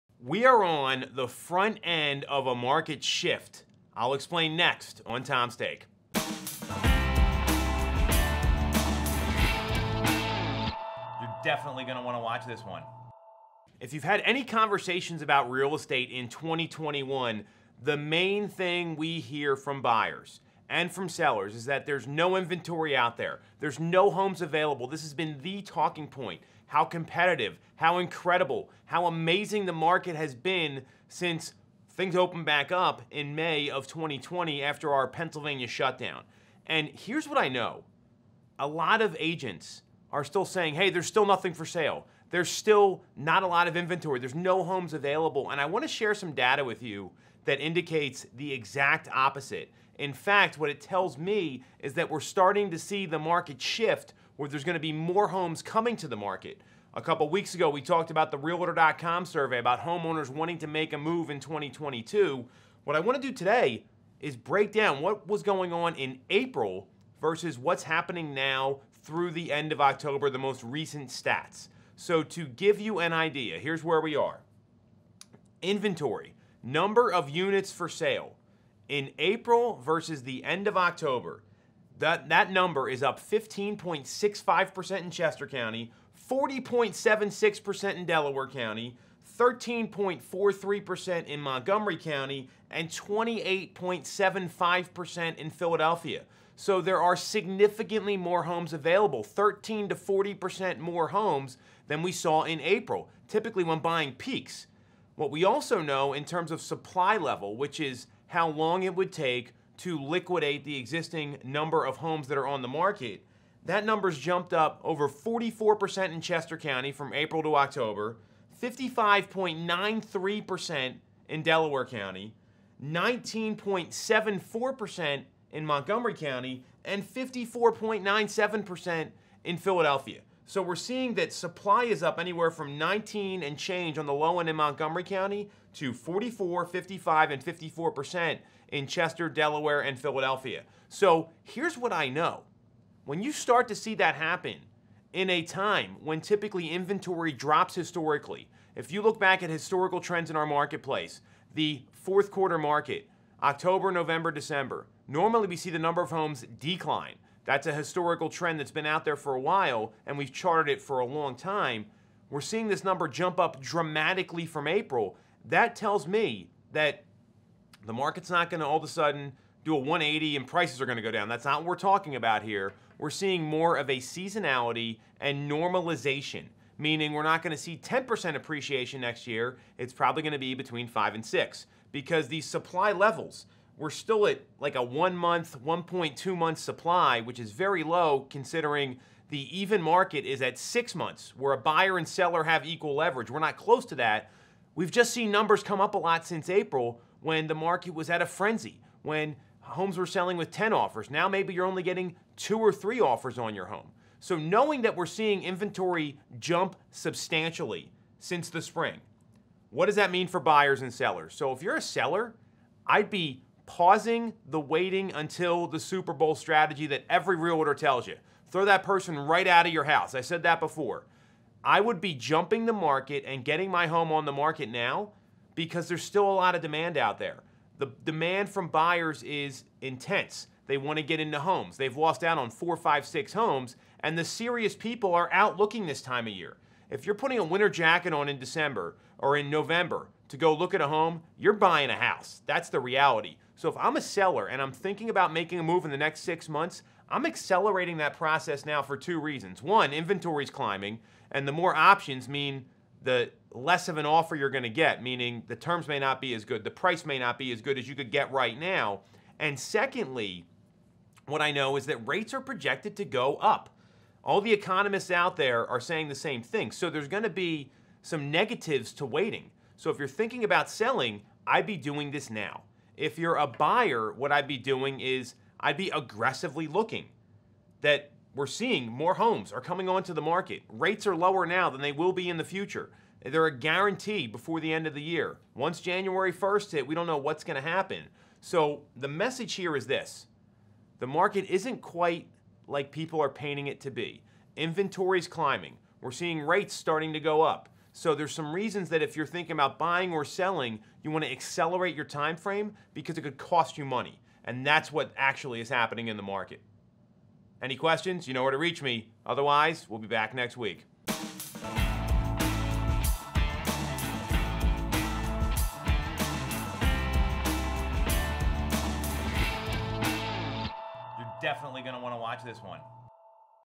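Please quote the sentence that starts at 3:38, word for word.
Throw that person right out of your house.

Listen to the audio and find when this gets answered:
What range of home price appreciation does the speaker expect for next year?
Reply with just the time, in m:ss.
3:00.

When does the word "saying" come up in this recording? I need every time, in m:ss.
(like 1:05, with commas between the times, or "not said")
0:40, 4:25.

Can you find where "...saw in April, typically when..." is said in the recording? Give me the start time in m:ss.
1:42.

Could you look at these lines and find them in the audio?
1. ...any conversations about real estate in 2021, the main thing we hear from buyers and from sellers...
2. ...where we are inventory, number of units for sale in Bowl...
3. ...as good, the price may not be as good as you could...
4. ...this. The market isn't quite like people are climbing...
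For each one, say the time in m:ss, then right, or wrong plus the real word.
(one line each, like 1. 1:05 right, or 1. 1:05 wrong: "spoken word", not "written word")
1. 0:14 right
2. 1:13 wrong: "April", not "Bowl"
3. 4:16 right
4. 4:49 wrong: "painting", not "climbing".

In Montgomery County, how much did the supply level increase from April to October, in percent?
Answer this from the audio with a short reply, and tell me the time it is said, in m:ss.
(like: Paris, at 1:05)
19.74%, at 2:02.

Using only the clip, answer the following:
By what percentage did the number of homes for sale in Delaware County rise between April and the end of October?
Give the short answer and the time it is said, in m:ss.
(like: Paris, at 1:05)
40.76%, at 1:26.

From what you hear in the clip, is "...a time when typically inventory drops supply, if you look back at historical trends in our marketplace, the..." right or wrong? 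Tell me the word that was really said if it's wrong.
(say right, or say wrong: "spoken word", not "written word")
wrong: "historically", not "supply".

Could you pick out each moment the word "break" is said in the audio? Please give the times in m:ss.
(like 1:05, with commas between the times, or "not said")
1:04.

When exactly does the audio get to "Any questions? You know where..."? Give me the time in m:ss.
5:07.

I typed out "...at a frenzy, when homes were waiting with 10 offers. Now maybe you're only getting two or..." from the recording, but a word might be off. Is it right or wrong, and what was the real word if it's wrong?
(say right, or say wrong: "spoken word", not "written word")
wrong: "selling", not "waiting".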